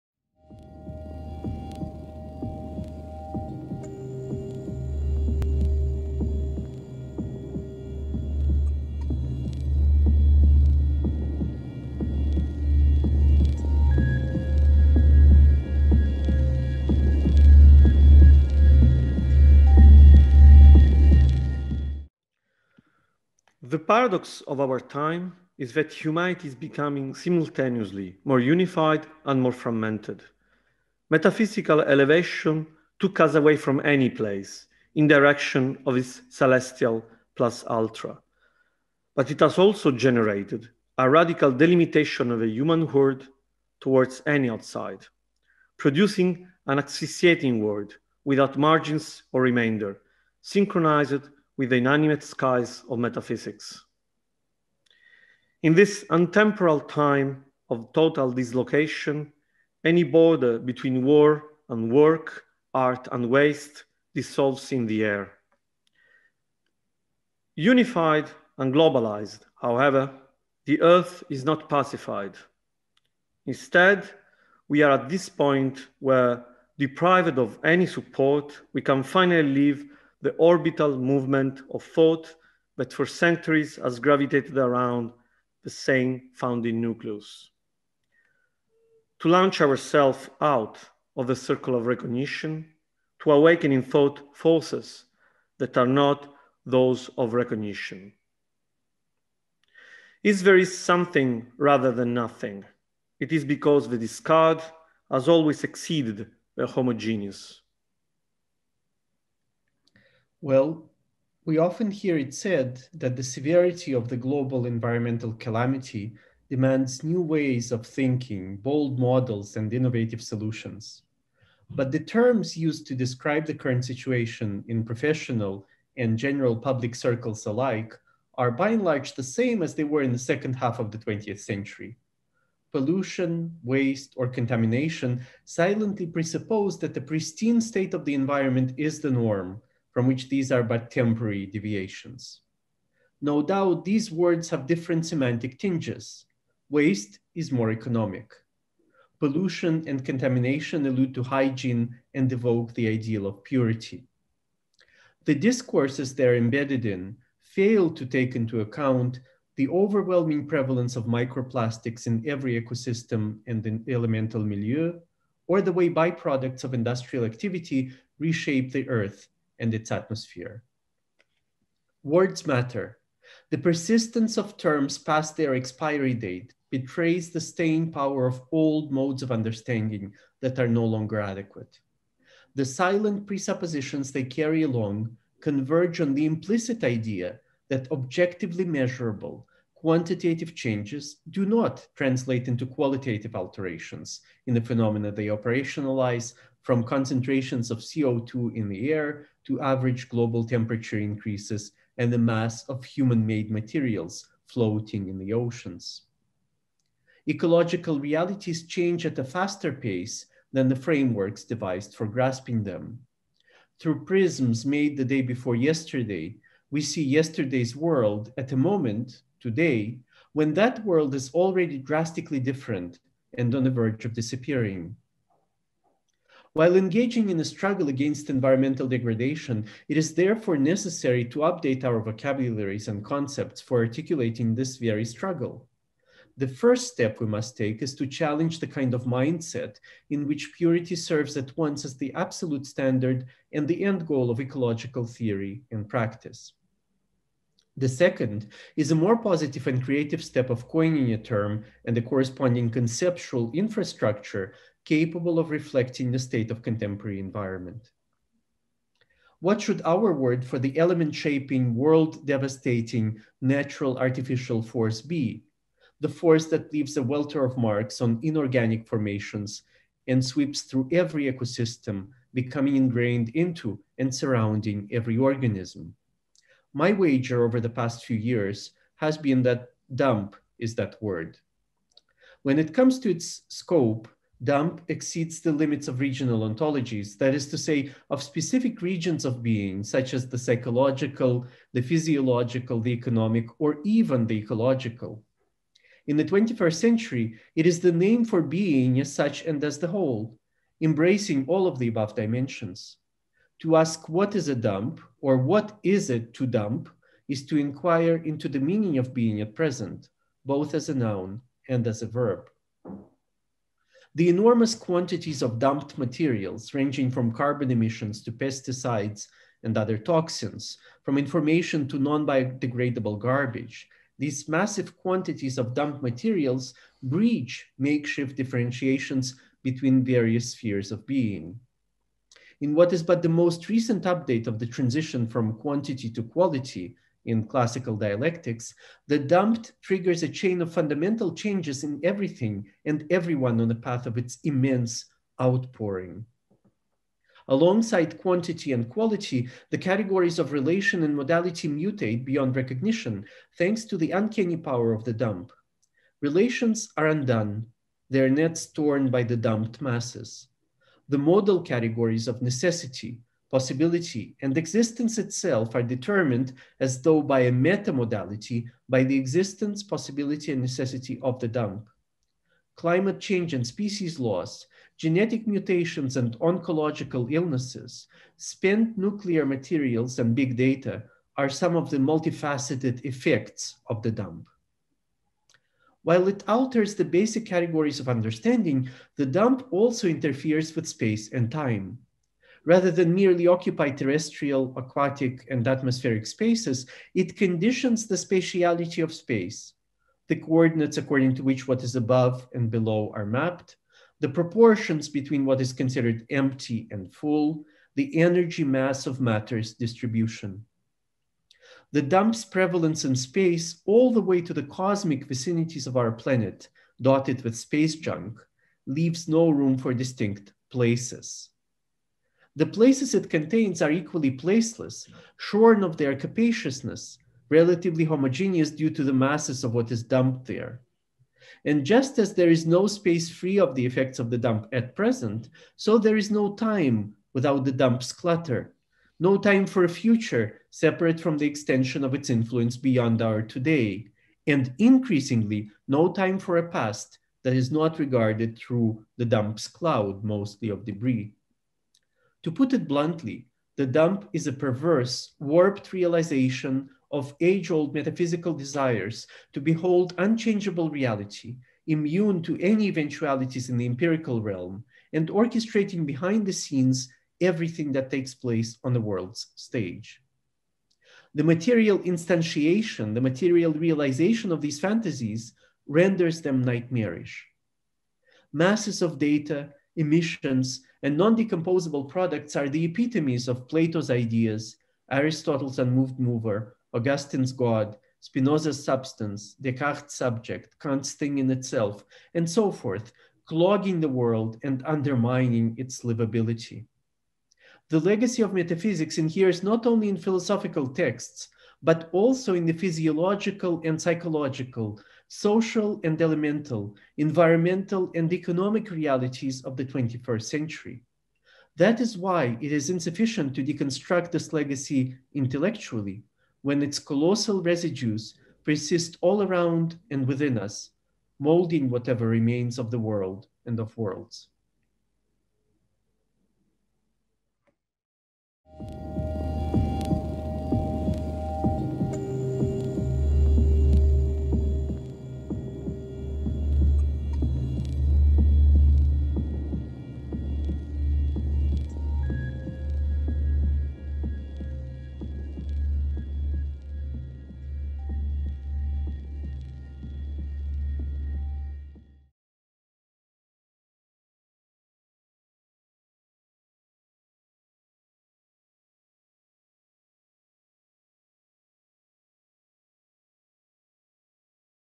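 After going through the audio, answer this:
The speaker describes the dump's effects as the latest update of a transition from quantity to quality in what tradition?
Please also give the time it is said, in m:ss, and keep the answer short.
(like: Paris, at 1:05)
classical dialectics, at 5:37.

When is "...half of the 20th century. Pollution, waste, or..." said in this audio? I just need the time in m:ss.
2:10.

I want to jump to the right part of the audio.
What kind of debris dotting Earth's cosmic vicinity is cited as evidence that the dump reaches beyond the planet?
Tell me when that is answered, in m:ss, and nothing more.
6:57.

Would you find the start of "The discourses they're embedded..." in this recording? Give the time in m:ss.
2:35.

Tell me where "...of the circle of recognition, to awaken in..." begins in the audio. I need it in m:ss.
1:31.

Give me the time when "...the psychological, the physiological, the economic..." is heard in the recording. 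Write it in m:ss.
4:50.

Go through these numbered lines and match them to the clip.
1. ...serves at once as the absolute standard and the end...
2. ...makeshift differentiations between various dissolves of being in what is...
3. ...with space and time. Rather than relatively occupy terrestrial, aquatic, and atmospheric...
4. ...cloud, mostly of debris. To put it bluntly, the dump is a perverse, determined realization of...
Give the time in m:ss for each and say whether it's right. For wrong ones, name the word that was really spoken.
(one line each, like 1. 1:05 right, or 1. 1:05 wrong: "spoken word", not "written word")
1. 4:00 right
2. 5:27 wrong: "spheres", not "dissolves"
3. 6:30 wrong: "merely", not "relatively"
4. 7:29 wrong: "warped", not "determined".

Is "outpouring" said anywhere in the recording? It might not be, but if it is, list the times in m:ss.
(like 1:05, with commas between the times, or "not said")
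5:45.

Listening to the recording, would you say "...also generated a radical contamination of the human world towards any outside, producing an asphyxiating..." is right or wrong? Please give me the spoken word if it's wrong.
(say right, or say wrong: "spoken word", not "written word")
wrong: "delimitation", not "contamination".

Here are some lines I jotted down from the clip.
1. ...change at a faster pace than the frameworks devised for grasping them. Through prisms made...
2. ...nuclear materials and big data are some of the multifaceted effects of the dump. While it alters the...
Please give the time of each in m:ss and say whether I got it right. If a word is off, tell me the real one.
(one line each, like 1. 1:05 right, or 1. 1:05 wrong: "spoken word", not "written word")
1. 3:28 right
2. 6:18 right.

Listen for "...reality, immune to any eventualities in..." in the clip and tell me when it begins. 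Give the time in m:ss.
7:40.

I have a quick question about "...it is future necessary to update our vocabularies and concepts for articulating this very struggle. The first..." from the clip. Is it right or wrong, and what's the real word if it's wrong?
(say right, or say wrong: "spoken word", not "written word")
wrong: "therefore", not "future".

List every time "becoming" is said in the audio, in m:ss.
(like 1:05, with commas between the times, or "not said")
0:26, 4:32.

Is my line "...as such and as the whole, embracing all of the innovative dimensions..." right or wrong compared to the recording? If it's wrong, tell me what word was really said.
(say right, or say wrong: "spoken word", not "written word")
wrong: "above", not "innovative".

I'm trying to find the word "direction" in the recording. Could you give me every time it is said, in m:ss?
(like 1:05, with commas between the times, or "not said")
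0:35.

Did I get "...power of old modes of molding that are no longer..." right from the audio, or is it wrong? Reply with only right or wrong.
wrong.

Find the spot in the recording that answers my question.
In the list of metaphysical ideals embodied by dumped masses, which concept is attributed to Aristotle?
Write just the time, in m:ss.
8:05.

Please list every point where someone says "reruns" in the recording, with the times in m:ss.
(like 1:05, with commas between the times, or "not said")
not said.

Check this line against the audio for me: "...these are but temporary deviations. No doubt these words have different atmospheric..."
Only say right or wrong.
wrong.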